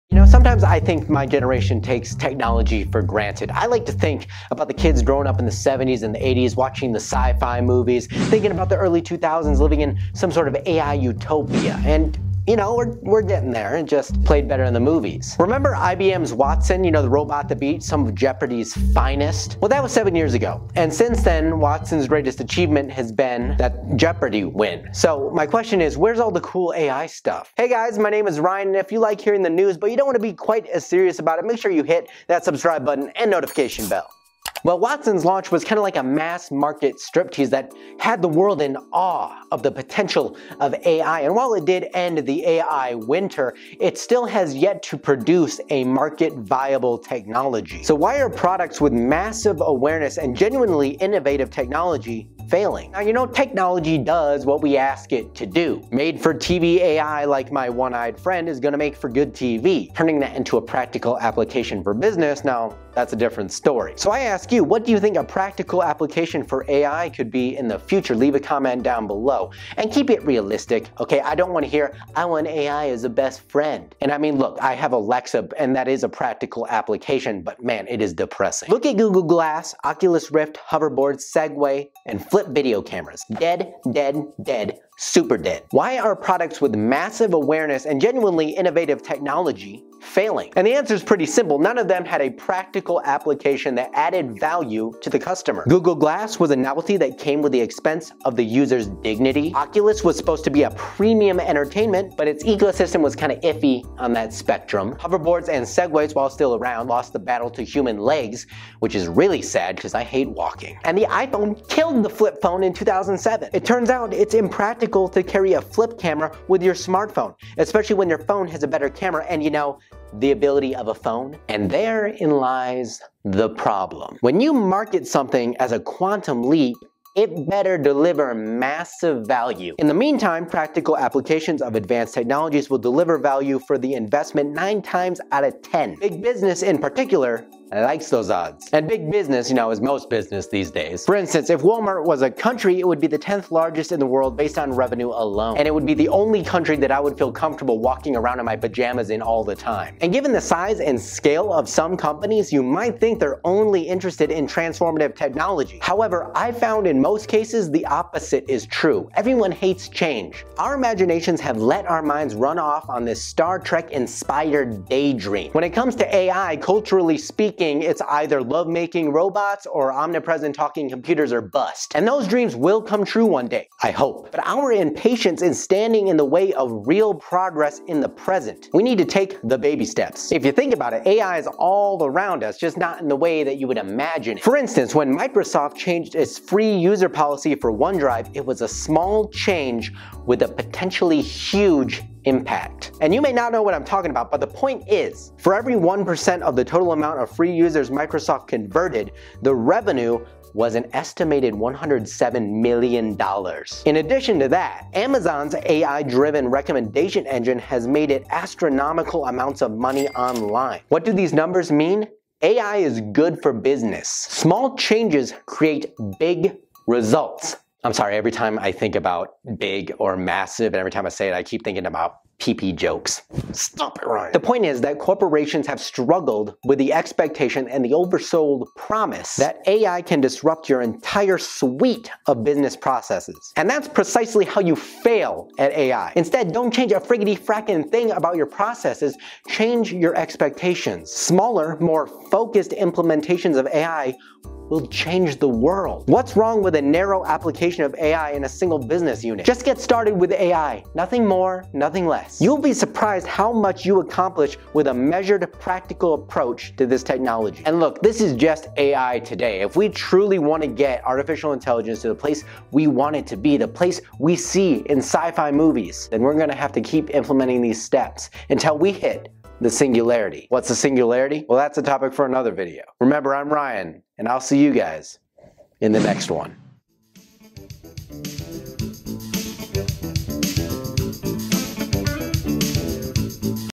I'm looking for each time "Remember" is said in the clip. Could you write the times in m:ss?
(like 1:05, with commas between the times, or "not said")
0:15, 4:32.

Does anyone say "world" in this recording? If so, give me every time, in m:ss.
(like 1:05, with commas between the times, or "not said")
0:38, 2:24, 4:05.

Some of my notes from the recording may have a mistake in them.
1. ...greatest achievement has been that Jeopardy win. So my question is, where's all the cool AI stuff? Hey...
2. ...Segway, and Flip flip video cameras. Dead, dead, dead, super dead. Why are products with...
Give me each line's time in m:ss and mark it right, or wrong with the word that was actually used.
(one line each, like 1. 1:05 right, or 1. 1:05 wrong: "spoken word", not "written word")
1. 0:22 right
2. 1:21 right.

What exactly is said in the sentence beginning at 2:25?
And it would be the only country that I would feel comfortable walking around in my pajamas in all the time.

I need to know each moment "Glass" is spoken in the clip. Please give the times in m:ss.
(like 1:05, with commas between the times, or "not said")
1:19, 1:35.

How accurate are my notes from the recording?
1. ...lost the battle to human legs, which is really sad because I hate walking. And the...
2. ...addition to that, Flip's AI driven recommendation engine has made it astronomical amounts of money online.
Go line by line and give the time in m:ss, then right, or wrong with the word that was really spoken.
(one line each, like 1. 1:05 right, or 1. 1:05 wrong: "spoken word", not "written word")
1. 1:46 right
2. 3:24 wrong: "Amazon", not "Flip".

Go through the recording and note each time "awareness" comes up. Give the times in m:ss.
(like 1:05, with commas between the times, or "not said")
0:49, 1:27.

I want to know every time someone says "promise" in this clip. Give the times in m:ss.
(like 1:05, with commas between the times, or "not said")
3:48.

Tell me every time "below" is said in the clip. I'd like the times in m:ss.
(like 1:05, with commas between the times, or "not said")
1:09.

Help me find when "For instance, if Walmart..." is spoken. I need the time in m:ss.
2:21.